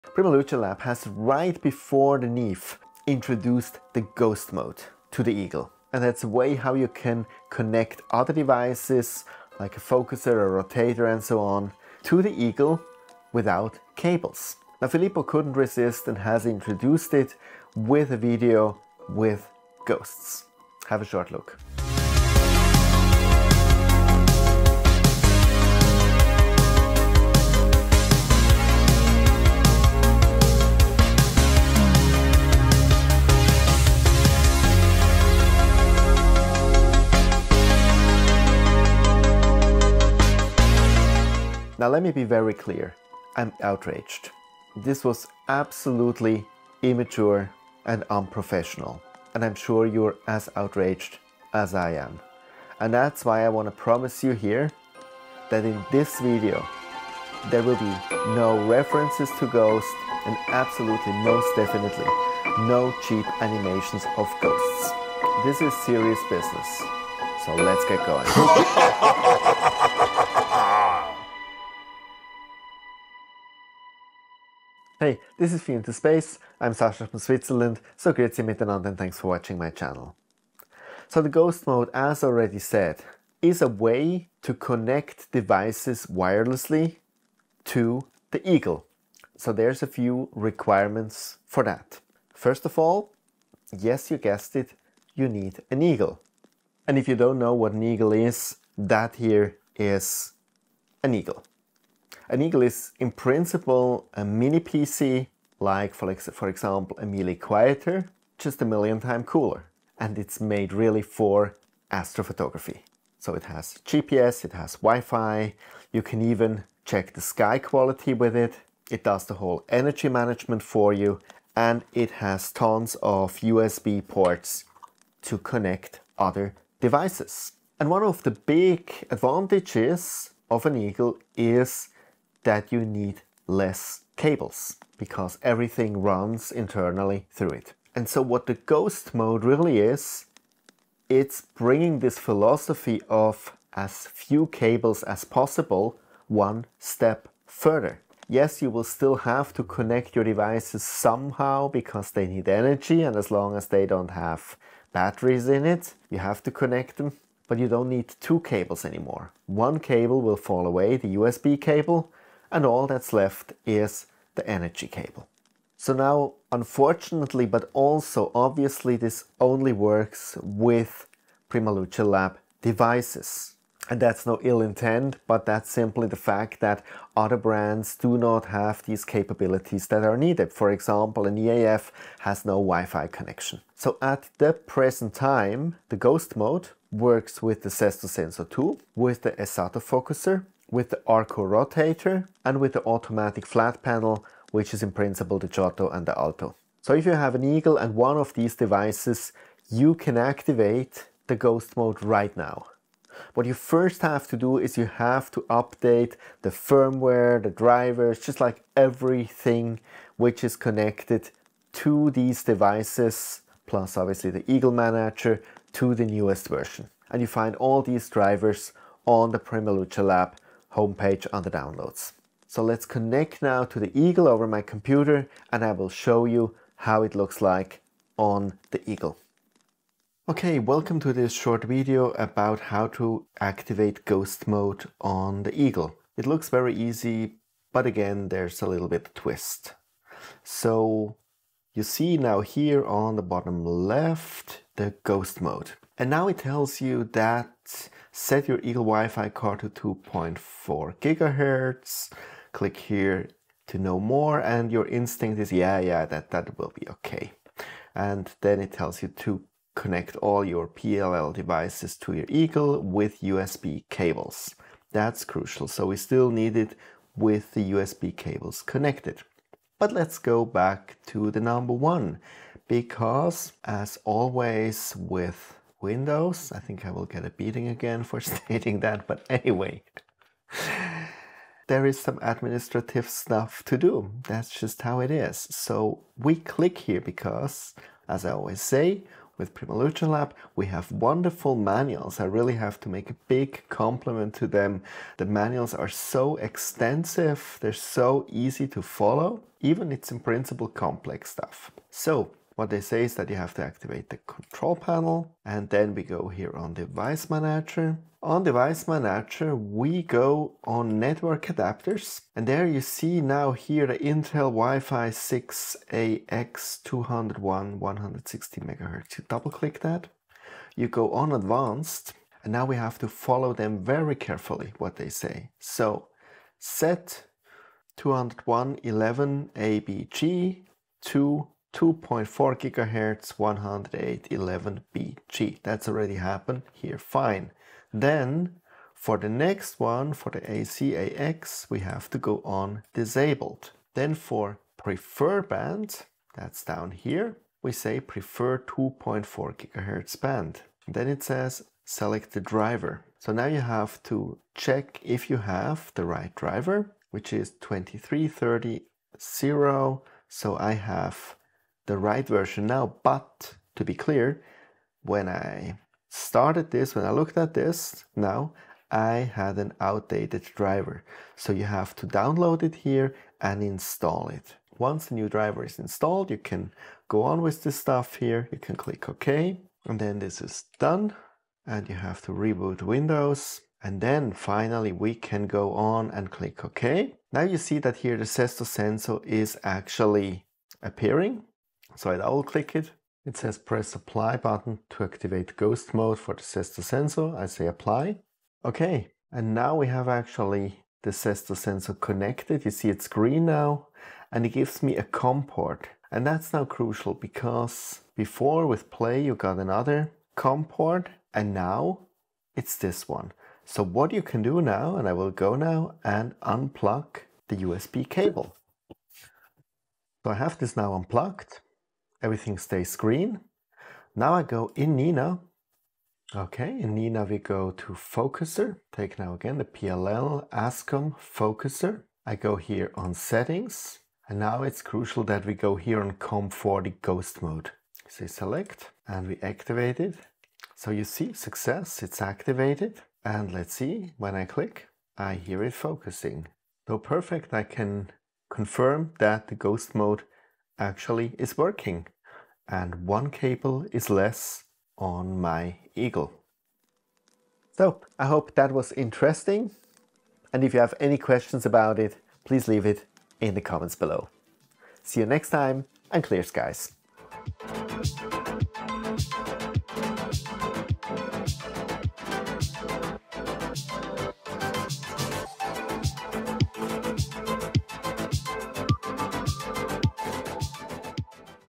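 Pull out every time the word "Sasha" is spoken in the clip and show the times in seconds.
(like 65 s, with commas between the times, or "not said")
76 s.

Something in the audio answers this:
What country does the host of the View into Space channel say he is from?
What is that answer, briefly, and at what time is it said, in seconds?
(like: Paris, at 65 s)
Switzerland, at 77 s.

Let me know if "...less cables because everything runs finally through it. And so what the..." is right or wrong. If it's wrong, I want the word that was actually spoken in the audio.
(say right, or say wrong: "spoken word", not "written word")
wrong: "internally", not "finally".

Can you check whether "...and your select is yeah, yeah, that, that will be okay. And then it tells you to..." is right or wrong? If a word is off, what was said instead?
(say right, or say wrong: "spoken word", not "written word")
wrong: "instinct", not "select".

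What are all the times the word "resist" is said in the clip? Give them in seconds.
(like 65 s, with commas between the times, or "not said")
15 s.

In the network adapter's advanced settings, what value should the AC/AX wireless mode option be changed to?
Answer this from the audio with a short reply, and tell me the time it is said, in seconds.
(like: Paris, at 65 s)
disabled, at 342 s.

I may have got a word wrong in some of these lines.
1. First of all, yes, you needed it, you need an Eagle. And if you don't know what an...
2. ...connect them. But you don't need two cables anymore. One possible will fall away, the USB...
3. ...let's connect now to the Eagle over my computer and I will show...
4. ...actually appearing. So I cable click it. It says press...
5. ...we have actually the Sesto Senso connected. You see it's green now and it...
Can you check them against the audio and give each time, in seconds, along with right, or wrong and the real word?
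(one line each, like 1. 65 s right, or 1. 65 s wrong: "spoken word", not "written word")
1. 92 s wrong: "guessed", not "needed"
2. 156 s wrong: "cable", not "possible"
3. 222 s right
4. 389 s wrong: "double", not "cable"
5. 399 s right.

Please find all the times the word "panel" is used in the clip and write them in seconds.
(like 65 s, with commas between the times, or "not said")
193 s, 304 s.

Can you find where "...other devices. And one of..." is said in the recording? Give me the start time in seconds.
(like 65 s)
126 s.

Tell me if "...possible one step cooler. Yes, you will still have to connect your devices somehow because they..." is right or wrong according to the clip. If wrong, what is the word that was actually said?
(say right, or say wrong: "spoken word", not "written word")
wrong: "further", not "cooler".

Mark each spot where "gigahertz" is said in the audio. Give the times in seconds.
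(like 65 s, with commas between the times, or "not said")
250 s, 332 s, 349 s.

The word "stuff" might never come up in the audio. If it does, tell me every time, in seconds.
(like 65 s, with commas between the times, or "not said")
283 s, 301 s, 377 s.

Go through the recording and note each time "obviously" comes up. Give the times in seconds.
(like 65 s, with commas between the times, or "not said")
168 s, 213 s.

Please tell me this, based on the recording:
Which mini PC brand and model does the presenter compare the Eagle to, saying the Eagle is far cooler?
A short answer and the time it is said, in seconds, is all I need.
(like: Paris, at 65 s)
MeLE Quieter, at 107 s.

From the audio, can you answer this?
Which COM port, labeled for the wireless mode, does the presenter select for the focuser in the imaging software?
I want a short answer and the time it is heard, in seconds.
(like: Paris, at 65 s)
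COM40, at 436 s.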